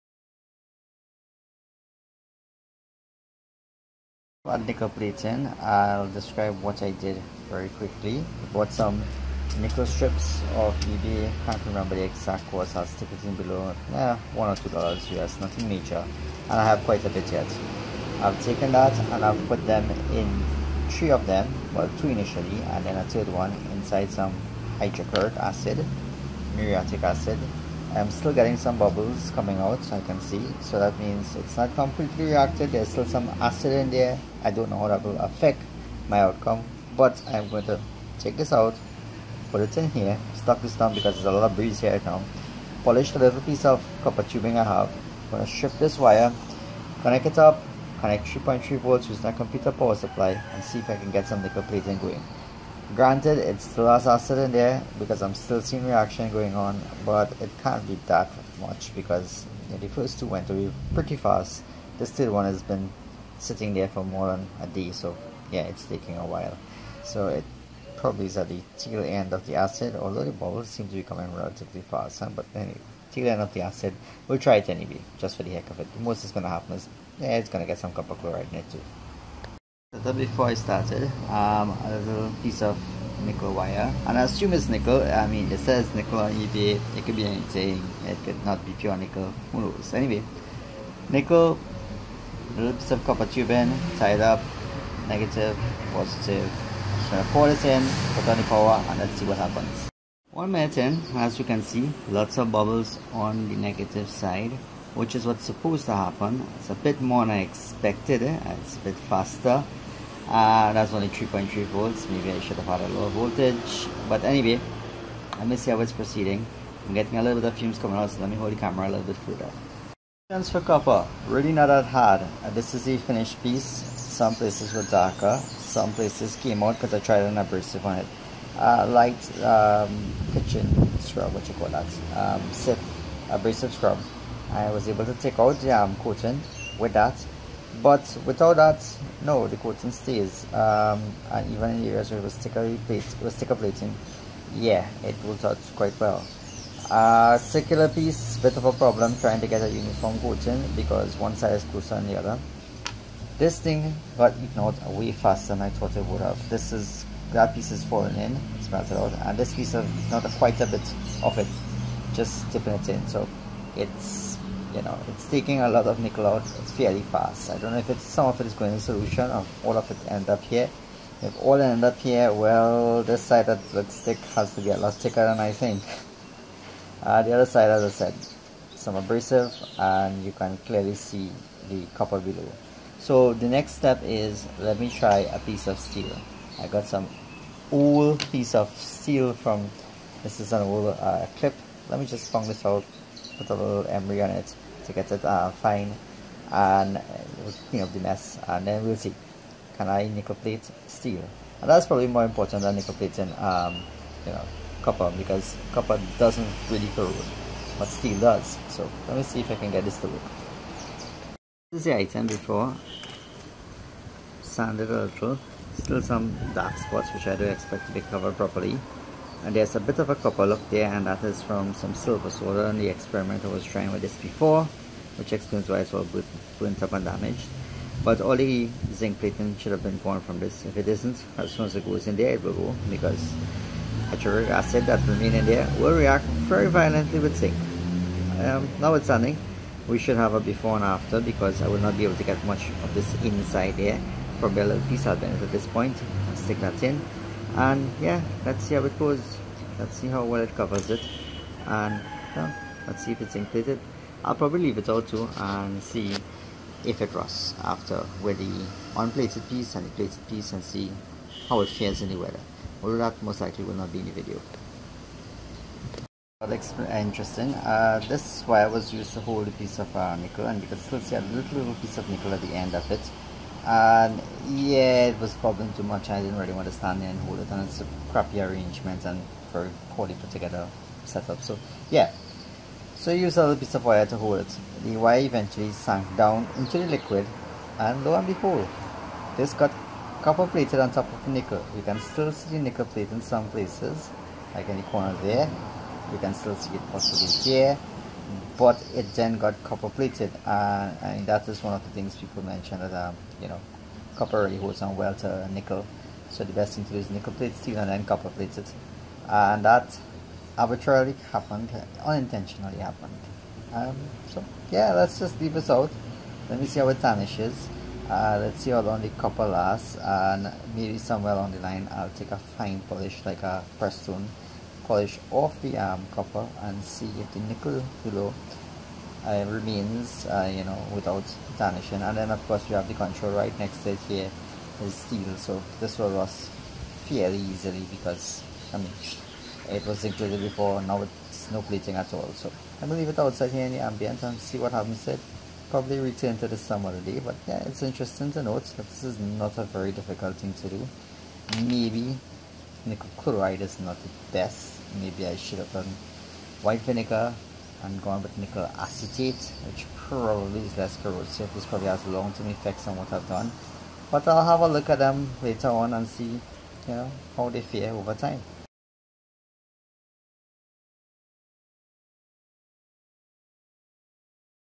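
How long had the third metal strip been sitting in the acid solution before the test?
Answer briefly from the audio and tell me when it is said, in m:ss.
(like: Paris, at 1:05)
more than a day, at 1:04.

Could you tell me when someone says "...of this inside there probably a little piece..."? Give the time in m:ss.
4:02.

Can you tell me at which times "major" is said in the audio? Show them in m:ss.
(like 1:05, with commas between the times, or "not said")
0:15.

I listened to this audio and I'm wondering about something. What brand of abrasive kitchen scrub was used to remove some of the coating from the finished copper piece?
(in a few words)
Cif.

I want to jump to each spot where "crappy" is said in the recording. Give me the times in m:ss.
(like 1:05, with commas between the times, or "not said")
4:38.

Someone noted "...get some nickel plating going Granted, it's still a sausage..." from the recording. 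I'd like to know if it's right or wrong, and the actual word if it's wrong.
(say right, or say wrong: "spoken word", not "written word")
right.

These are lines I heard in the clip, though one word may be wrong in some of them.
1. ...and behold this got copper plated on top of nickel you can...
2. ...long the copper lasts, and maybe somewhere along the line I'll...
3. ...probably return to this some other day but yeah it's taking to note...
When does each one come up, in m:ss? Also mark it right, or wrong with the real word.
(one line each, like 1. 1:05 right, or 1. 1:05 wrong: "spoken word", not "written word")
1. 4:48 right
2. 5:18 right
3. 5:45 wrong: "interesting", not "taking".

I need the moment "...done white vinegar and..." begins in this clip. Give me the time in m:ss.
5:55.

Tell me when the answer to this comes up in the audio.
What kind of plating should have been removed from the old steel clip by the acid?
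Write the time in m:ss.
3:48.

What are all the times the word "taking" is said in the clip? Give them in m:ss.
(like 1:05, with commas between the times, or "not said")
1:05, 2:45.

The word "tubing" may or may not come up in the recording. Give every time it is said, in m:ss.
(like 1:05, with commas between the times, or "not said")
0:44, 1:33.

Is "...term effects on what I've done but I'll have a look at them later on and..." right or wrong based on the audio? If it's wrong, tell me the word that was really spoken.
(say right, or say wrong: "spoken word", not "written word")
right.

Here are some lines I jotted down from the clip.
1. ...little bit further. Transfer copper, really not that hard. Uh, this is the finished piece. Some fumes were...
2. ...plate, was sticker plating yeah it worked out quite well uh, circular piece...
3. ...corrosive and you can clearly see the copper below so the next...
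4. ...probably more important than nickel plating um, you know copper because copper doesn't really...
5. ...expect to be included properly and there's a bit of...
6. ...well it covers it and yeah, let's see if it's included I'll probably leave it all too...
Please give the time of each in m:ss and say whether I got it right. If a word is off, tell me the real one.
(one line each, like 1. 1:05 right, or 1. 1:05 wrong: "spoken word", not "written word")
1. 1:58 wrong: "places", not "fumes"
2. 2:22 right
3. 2:58 wrong: "abrasive", not "corrosive"
4. 3:21 right
5. 3:37 wrong: "covered", not "included"
6. 4:10 right.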